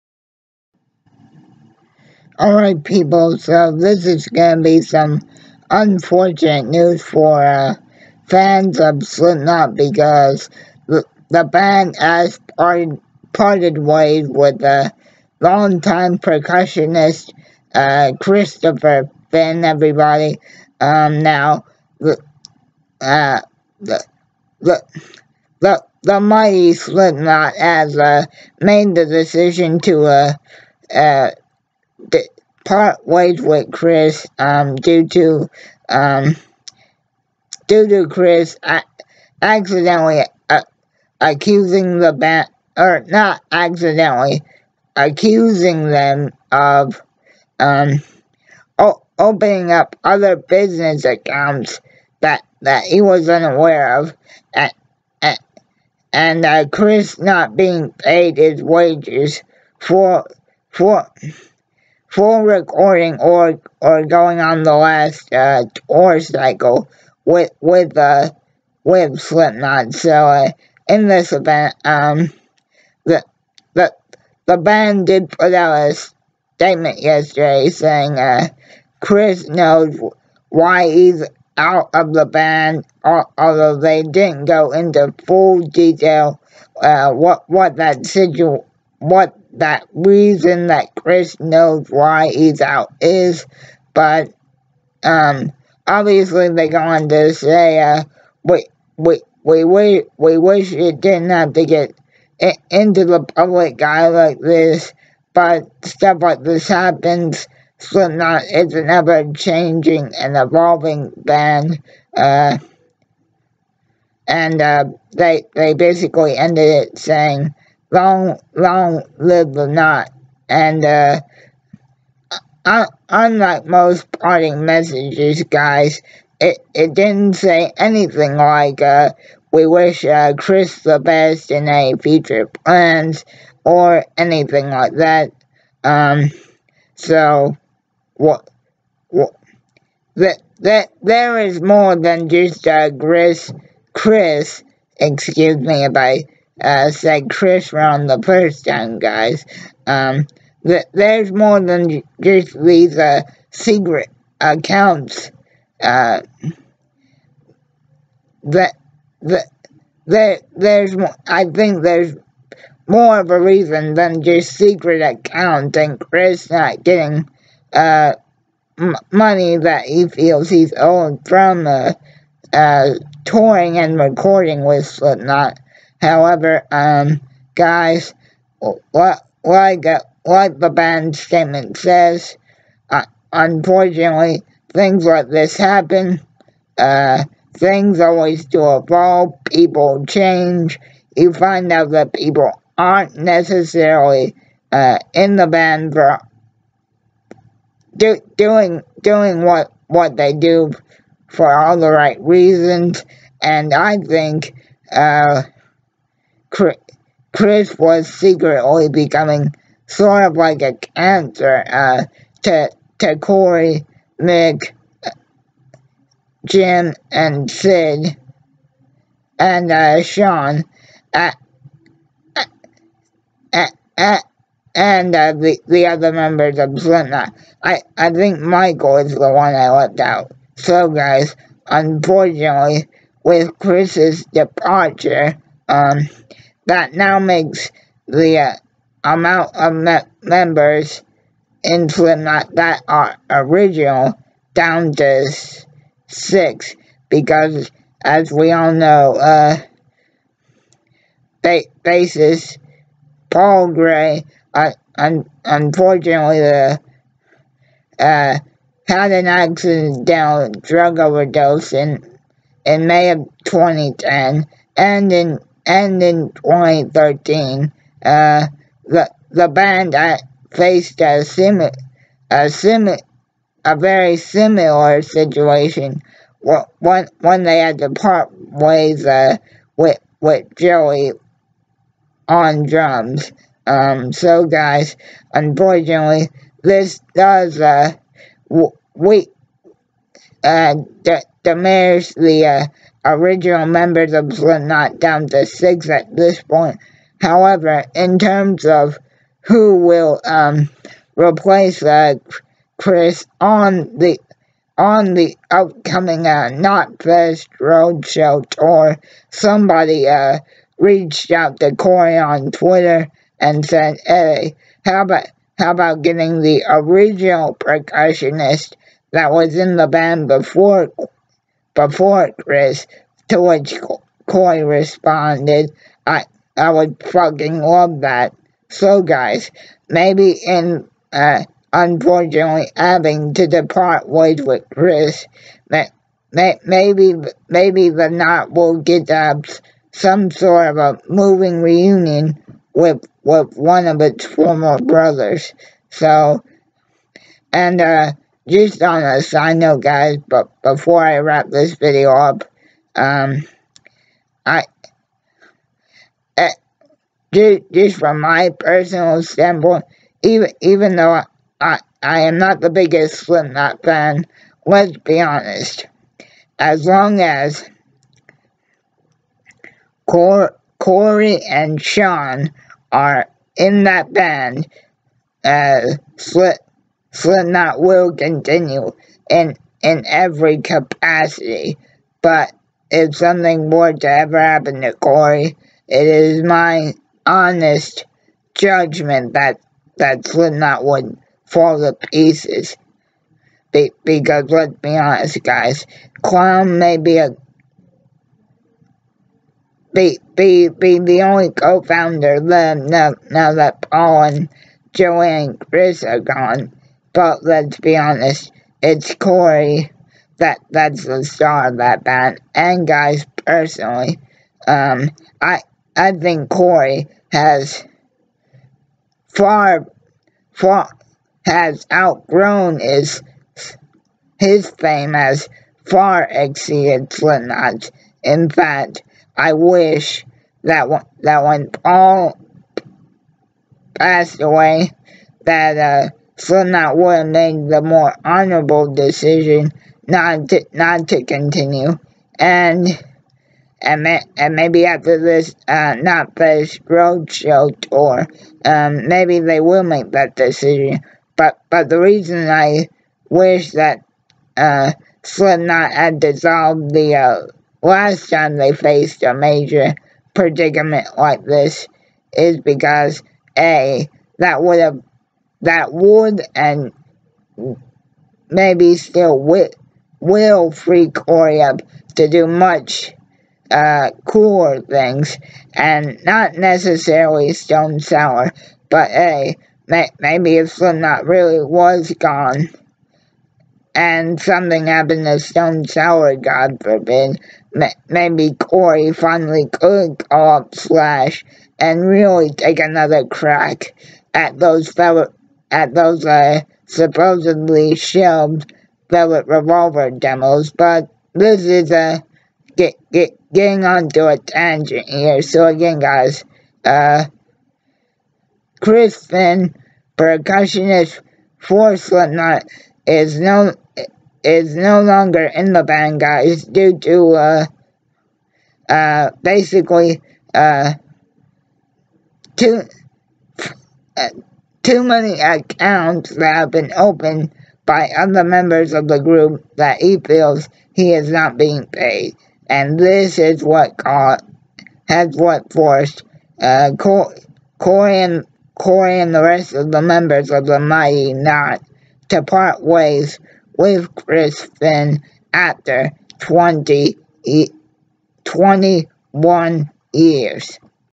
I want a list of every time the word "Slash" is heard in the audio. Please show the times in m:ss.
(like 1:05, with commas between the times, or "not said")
8:10.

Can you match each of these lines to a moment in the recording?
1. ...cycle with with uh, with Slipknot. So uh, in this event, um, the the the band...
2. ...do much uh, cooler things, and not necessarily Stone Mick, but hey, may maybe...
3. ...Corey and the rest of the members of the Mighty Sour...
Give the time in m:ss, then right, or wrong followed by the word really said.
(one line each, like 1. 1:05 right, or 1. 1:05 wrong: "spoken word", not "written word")
1. 1:06 right
2. 7:52 wrong: "Sour", not "Mick"
3. 8:58 wrong: "Knot", not "Sour".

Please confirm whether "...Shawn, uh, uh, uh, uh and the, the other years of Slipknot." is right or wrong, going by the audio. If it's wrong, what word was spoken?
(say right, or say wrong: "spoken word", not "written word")
wrong: "members", not "years".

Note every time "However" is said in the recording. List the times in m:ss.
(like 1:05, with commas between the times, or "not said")
2:56, 4:57.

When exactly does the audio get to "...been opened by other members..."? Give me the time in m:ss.
8:46.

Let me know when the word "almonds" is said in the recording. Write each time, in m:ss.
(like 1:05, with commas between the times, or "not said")
not said.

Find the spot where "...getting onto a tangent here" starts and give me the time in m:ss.
8:23.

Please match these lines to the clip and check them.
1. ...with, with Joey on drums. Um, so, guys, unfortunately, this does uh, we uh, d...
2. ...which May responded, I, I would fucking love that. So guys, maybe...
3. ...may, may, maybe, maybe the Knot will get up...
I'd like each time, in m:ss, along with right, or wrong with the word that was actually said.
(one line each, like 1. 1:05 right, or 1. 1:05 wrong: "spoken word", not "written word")
1. 4:39 right
2. 5:23 wrong: "Corey", not "May"
3. 5:35 right.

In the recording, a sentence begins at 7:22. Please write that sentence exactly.
And and, may, and maybe after this uh, not this roadshow tour, um, maybe they will make that decision.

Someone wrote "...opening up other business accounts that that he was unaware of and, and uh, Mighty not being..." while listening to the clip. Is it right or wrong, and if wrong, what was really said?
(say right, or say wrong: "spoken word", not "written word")
wrong: "Chris", not "Mighty".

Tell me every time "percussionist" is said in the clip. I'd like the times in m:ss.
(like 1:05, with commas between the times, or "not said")
0:16, 5:17, 8:30.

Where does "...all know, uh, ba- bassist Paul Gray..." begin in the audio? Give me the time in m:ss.
4:08.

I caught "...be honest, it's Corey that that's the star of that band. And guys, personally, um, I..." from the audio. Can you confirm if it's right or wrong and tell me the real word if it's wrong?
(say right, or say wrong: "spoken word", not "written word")
right.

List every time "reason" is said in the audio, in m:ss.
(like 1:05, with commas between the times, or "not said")
1:29, 2:43, 3:22, 7:31.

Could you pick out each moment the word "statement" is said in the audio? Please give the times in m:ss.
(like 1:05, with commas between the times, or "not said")
1:16, 3:01.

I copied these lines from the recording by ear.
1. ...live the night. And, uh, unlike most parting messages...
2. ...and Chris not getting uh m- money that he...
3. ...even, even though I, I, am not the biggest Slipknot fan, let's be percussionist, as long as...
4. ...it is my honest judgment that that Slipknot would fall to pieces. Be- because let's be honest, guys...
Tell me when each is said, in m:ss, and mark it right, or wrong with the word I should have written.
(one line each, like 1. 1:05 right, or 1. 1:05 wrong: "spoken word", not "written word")
1. 1:59 right
2. 2:45 right
3. 6:00 wrong: "honest", not "percussionist"
4. 6:25 right.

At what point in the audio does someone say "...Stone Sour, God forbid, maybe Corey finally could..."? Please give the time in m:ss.
8:05.